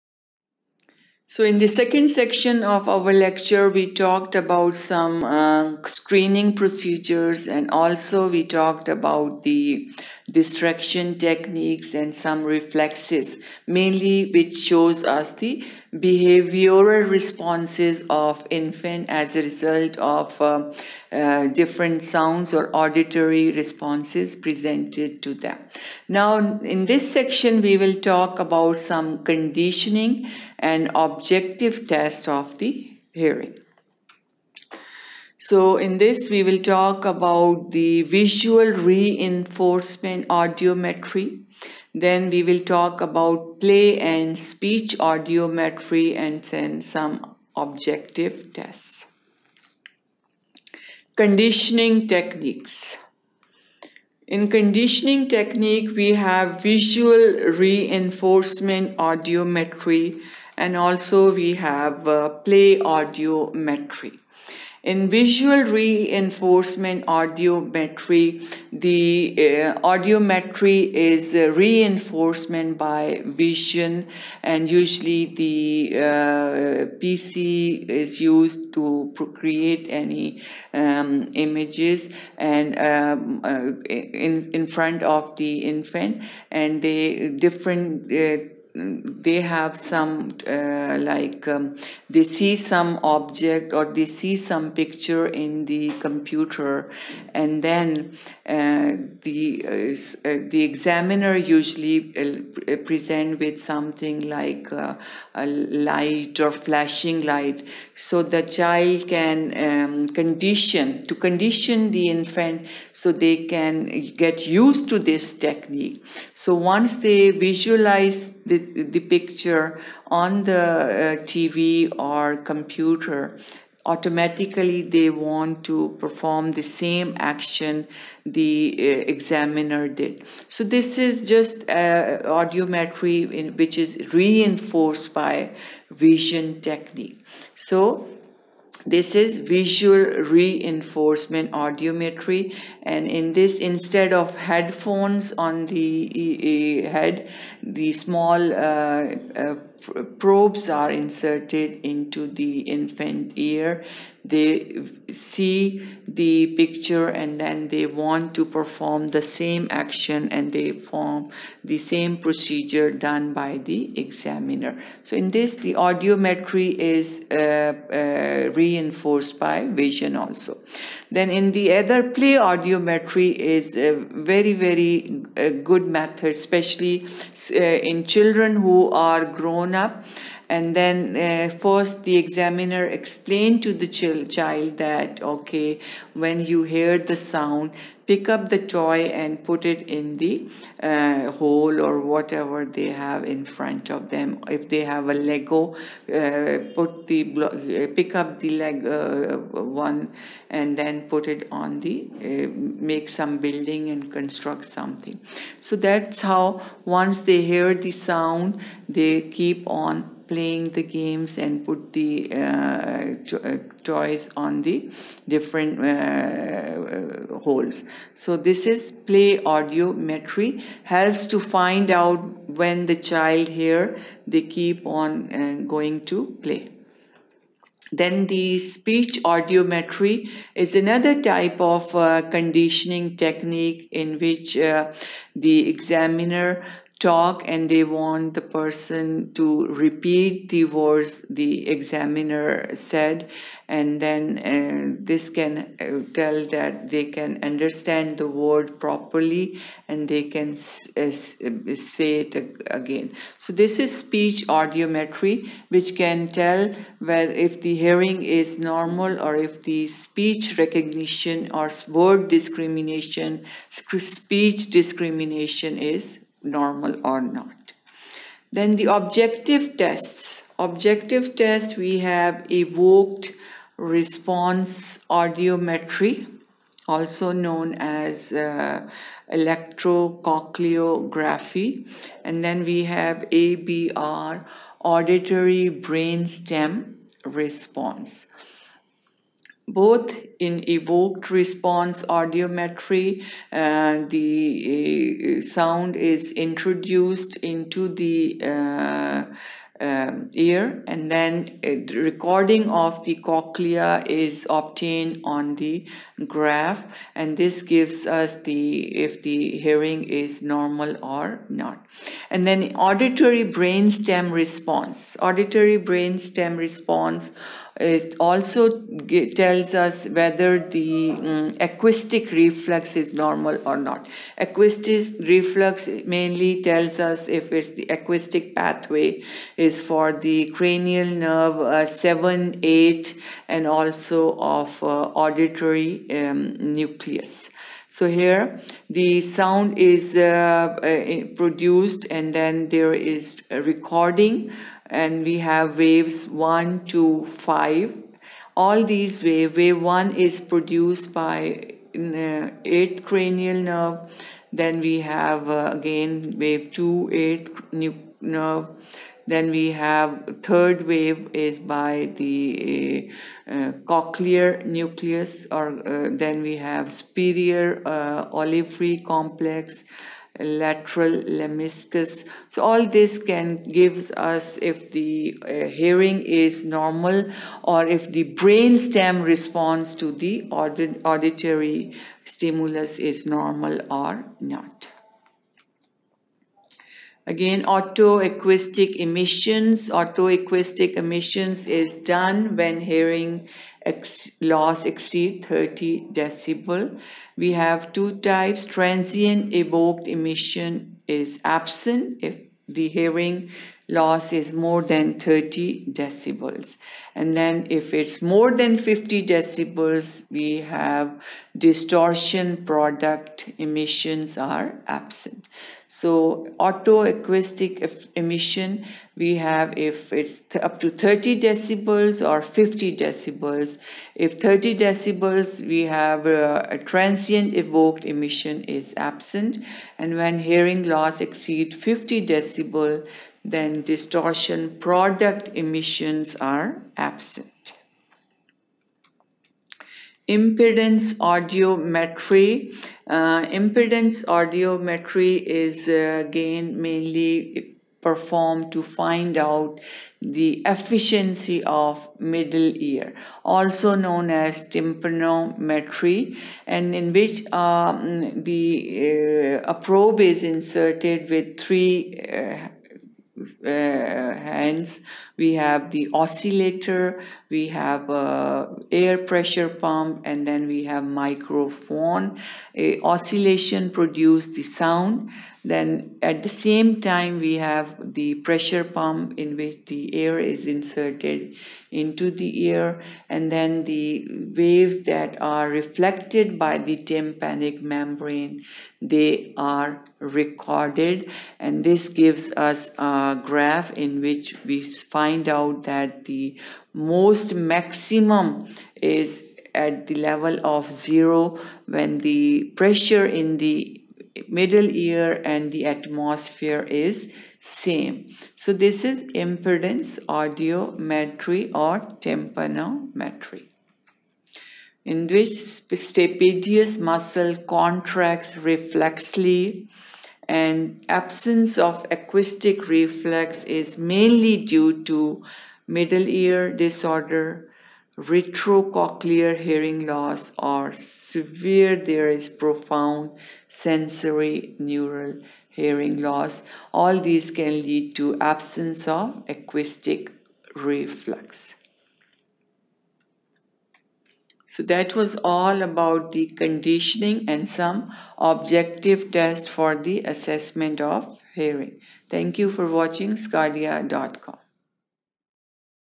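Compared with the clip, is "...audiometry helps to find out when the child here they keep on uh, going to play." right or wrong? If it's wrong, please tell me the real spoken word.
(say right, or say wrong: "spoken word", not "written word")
right.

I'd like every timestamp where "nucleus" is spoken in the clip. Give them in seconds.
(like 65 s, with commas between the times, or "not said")
336 s, 364 s.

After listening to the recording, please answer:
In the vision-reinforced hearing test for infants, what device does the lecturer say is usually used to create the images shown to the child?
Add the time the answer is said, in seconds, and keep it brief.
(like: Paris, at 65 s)
PC, at 76 s.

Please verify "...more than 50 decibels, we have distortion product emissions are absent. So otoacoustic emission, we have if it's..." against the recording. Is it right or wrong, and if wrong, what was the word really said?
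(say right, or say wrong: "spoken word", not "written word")
right.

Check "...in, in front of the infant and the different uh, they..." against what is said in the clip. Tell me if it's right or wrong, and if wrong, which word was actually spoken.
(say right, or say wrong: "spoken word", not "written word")
right.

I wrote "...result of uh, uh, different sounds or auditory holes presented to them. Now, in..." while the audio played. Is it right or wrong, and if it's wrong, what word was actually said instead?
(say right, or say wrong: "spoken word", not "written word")
wrong: "responses", not "holes".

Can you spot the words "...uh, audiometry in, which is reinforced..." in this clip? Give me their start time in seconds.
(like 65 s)
131 s.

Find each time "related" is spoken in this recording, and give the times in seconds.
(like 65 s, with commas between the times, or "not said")
not said.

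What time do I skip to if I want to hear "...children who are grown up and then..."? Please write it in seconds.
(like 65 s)
178 s.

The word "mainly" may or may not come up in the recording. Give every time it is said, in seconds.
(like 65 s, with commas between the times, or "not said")
13 s, 326 s, 446 s, 523 s.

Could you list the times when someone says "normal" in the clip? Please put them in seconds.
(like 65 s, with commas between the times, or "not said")
258 s, 266 s, 310 s, 323 s, 376 s, 383 s.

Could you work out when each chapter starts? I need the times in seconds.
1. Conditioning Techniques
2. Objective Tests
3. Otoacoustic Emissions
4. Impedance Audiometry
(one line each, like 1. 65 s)
1. 56 s
2. 268 s
3. 386 s
4. 440 s.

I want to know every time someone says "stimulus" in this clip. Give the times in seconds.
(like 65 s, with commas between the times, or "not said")
382 s.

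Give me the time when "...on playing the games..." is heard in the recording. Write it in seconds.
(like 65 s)
209 s.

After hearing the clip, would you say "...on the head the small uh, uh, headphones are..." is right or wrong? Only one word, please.
wrong.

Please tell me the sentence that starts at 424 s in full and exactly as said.
If 30 decibels, we have a, a transient evoked emission is absent.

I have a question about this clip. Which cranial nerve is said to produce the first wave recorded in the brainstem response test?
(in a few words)
8th cranial nerve.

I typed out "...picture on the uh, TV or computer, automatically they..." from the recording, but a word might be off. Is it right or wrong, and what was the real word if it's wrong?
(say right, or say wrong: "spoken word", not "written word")
right.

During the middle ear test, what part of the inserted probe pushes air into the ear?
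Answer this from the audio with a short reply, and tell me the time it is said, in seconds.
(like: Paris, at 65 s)
Air pressure pump, at 468 s.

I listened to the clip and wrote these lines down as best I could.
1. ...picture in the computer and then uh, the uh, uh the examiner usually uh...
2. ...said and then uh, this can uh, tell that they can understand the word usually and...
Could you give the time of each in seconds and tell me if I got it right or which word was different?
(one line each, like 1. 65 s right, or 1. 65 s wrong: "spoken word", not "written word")
1. 94 s right
2. 242 s wrong: "properly", not "usually".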